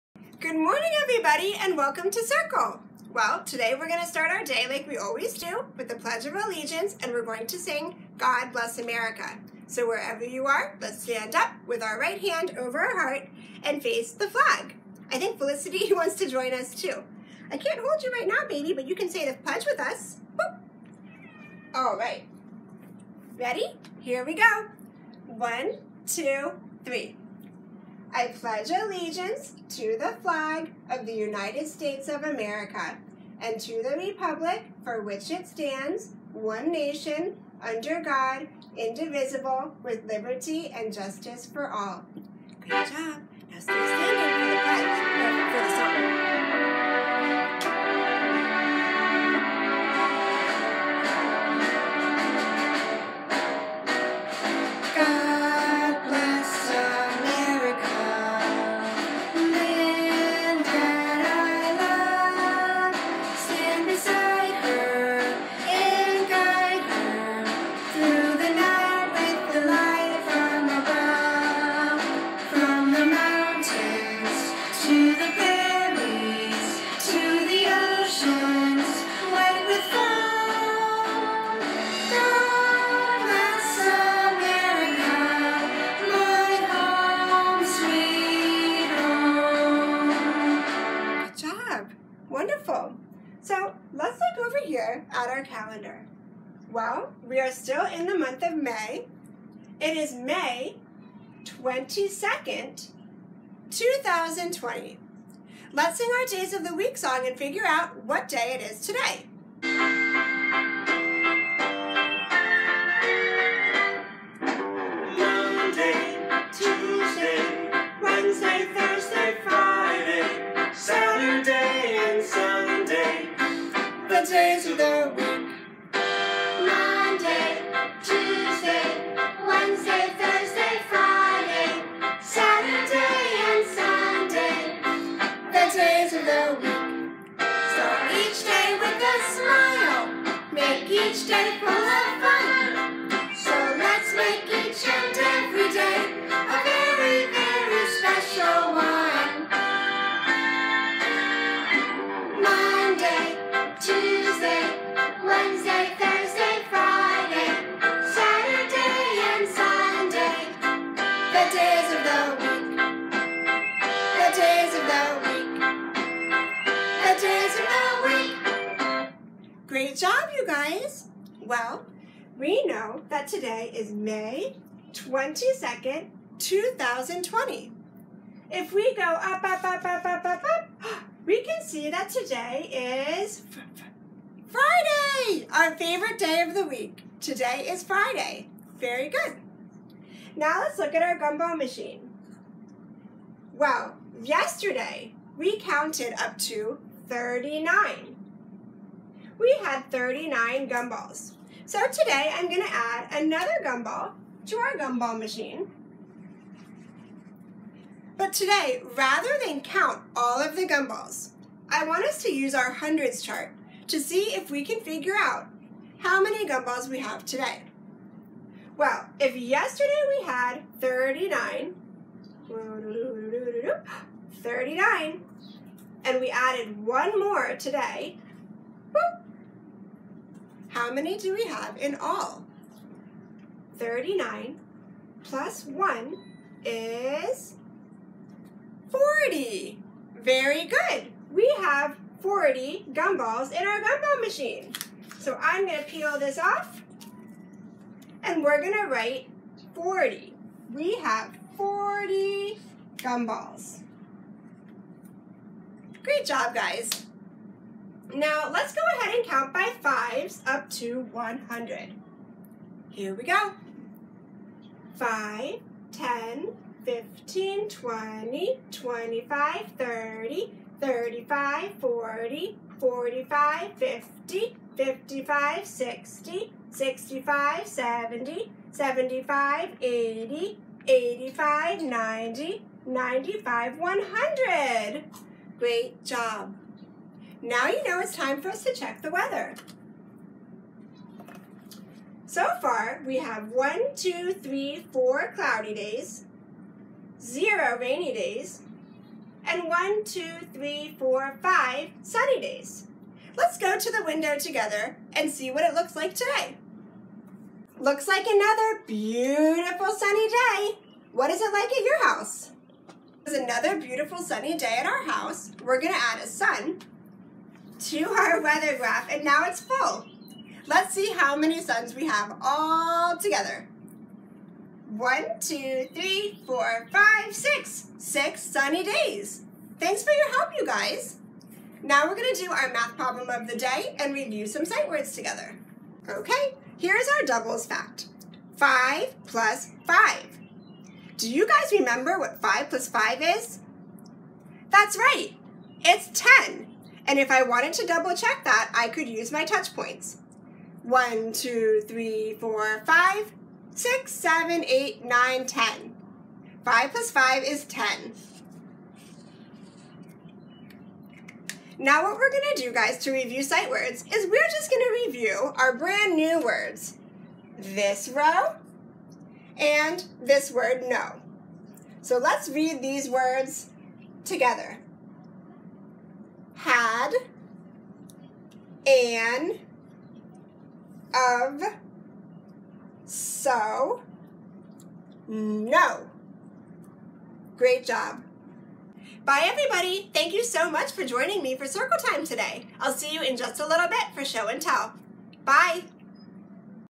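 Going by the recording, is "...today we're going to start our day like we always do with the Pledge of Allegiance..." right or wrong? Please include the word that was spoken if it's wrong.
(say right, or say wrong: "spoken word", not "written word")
right.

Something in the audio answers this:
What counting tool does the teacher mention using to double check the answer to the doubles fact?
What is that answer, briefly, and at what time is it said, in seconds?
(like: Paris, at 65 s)
touch points, at 349 s.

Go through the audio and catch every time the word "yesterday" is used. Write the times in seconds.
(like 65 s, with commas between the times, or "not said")
194 s, 219 s.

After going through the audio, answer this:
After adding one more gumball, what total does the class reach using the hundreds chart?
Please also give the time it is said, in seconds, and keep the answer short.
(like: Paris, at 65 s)
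40, at 233 s.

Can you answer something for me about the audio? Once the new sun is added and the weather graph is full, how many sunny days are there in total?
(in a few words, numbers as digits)
6.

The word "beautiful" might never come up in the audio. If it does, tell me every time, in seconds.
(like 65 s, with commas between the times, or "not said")
308 s, 313 s.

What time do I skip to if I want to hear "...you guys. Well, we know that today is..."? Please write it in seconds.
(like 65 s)
170 s.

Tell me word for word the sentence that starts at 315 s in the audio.
We're gonna add a sun to our weather graph and now it's full.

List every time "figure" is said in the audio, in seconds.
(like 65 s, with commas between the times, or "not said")
107 s, 214 s.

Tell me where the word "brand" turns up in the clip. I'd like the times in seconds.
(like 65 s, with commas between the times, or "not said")
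365 s.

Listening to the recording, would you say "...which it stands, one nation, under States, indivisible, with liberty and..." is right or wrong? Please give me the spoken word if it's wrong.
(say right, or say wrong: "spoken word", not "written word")
wrong: "God", not "States".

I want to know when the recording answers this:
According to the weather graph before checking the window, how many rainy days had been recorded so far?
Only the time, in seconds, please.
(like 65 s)
297 s.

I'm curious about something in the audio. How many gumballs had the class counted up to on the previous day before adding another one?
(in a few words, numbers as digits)
39.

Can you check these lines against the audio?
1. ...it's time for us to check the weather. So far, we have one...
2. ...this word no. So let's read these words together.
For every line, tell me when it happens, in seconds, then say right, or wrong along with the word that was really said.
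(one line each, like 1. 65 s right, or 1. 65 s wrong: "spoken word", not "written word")
1. 287 s right
2. 370 s right.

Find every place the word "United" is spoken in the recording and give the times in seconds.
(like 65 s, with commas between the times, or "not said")
31 s.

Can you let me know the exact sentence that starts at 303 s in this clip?
Let's go to the window together and see what it looks like today.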